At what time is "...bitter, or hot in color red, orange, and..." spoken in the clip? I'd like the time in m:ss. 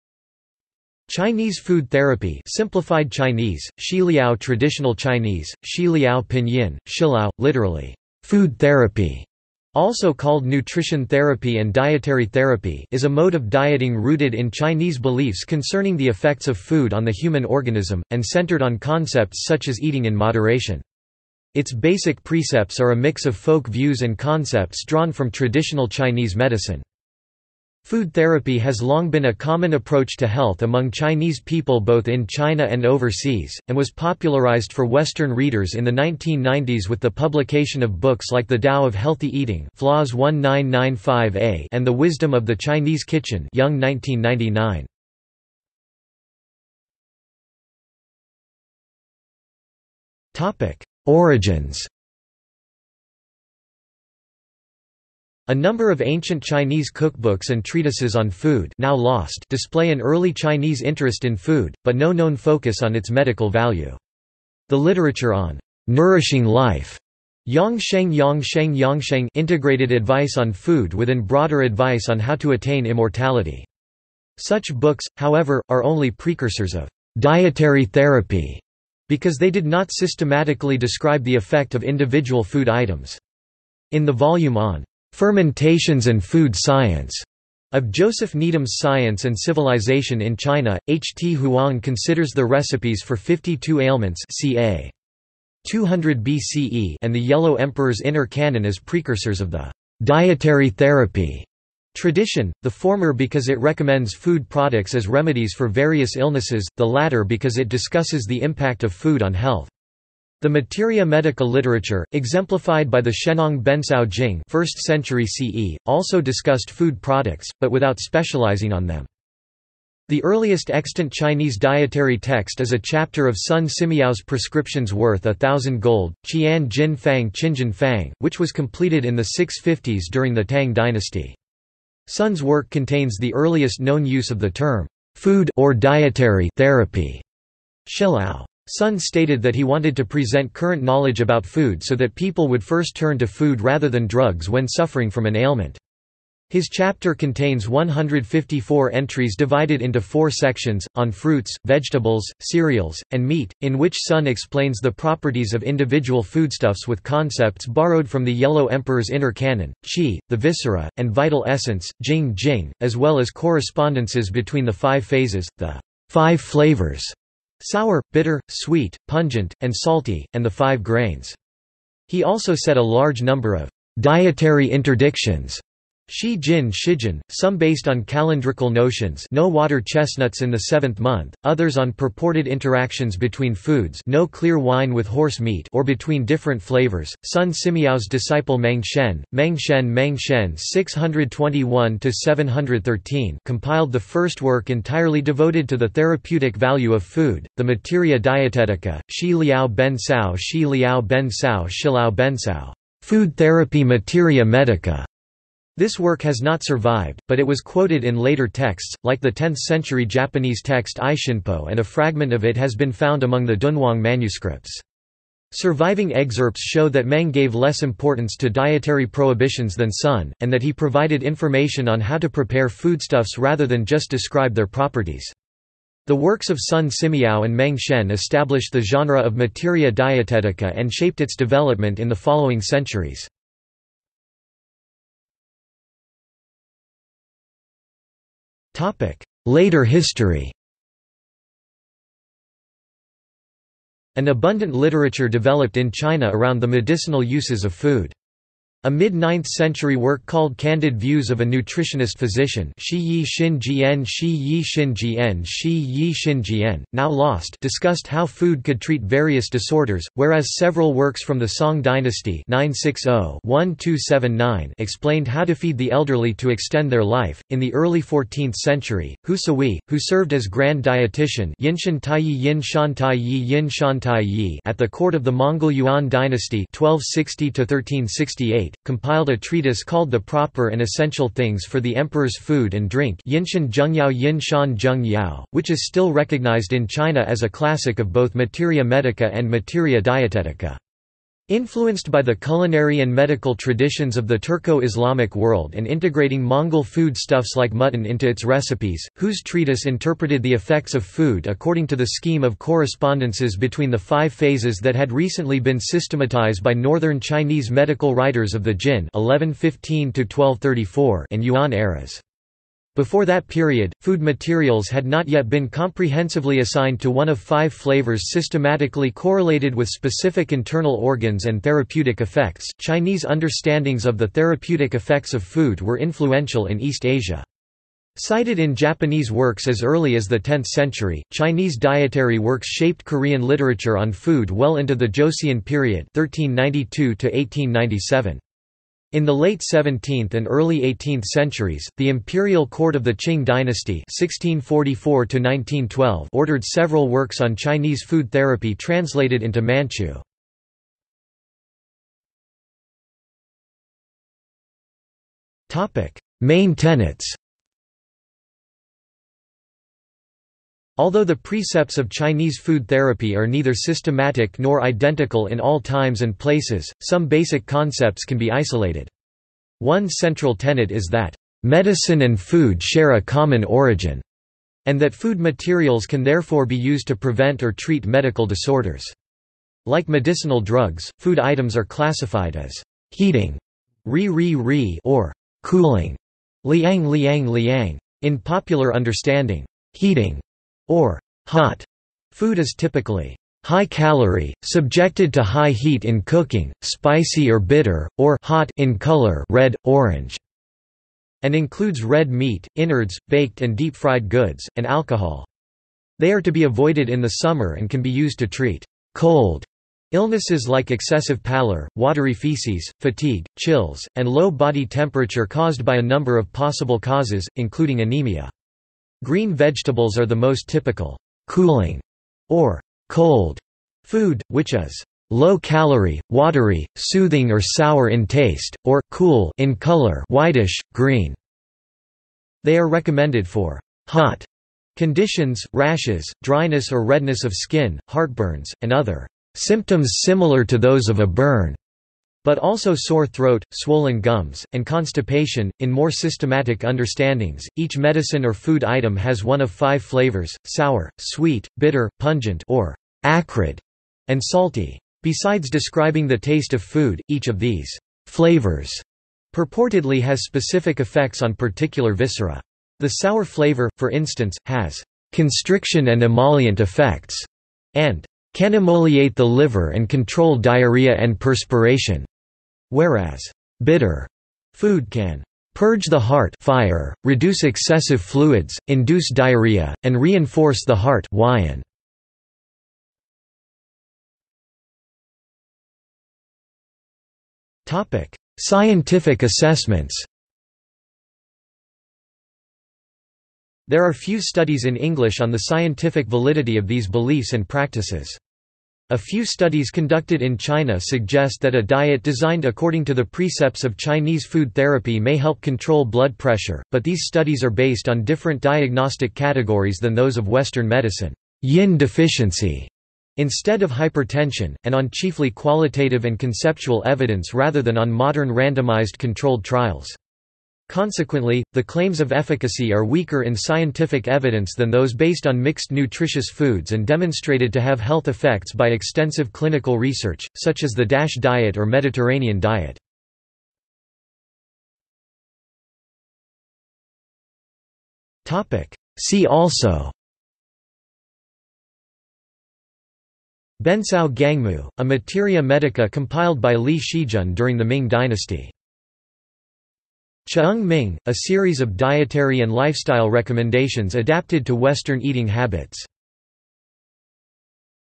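6:37.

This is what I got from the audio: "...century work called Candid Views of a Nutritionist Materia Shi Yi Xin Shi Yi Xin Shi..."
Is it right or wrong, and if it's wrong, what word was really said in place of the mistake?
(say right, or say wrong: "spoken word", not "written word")
wrong: "Physician", not "Materia".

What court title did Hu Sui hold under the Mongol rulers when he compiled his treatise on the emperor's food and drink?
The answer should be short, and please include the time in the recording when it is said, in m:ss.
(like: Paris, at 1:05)
grand dietitian, at 4:30.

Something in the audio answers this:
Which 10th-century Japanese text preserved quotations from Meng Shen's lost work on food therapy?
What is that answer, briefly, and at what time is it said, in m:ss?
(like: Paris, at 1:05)
Ishinpo, at 3:31.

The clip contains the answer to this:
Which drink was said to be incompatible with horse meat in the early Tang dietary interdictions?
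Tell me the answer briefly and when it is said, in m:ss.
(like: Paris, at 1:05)
clear wine, at 3:04.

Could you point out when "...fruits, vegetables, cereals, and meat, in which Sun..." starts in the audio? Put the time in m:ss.
2:31.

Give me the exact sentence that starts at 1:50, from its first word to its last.
The materia medica literature, exemplified by the Shennong Bencao Jing 1st century CE, also discussed food products, but without specializing on them.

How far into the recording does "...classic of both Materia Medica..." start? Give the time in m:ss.
4:47.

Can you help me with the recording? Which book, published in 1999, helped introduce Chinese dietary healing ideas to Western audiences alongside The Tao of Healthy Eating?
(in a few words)
The Wisdom of the Chinese Kitchen.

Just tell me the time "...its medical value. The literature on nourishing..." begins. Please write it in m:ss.
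1:02.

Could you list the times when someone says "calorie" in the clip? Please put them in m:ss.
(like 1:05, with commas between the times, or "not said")
6:33, 7:05.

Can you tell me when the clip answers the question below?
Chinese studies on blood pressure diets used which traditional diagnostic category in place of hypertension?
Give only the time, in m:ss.
8:31.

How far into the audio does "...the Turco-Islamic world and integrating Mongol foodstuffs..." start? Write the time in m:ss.
4:54.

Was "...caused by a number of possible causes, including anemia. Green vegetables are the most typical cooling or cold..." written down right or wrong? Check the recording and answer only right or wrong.
right.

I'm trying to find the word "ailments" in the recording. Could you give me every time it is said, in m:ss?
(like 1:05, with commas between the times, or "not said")
1:33, 2:25.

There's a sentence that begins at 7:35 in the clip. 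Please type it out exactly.
Besides describing the taste of food, each of these flavors purportedly has specific effects on particular viscera.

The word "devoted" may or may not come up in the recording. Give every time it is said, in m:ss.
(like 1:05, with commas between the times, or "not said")
3:15.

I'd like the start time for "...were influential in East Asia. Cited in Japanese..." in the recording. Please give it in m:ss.
5:25.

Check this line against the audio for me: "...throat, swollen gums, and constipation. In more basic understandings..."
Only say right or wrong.
wrong.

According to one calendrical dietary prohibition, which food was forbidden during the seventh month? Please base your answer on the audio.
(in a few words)
water chestnuts.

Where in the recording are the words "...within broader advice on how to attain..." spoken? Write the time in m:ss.
1:10.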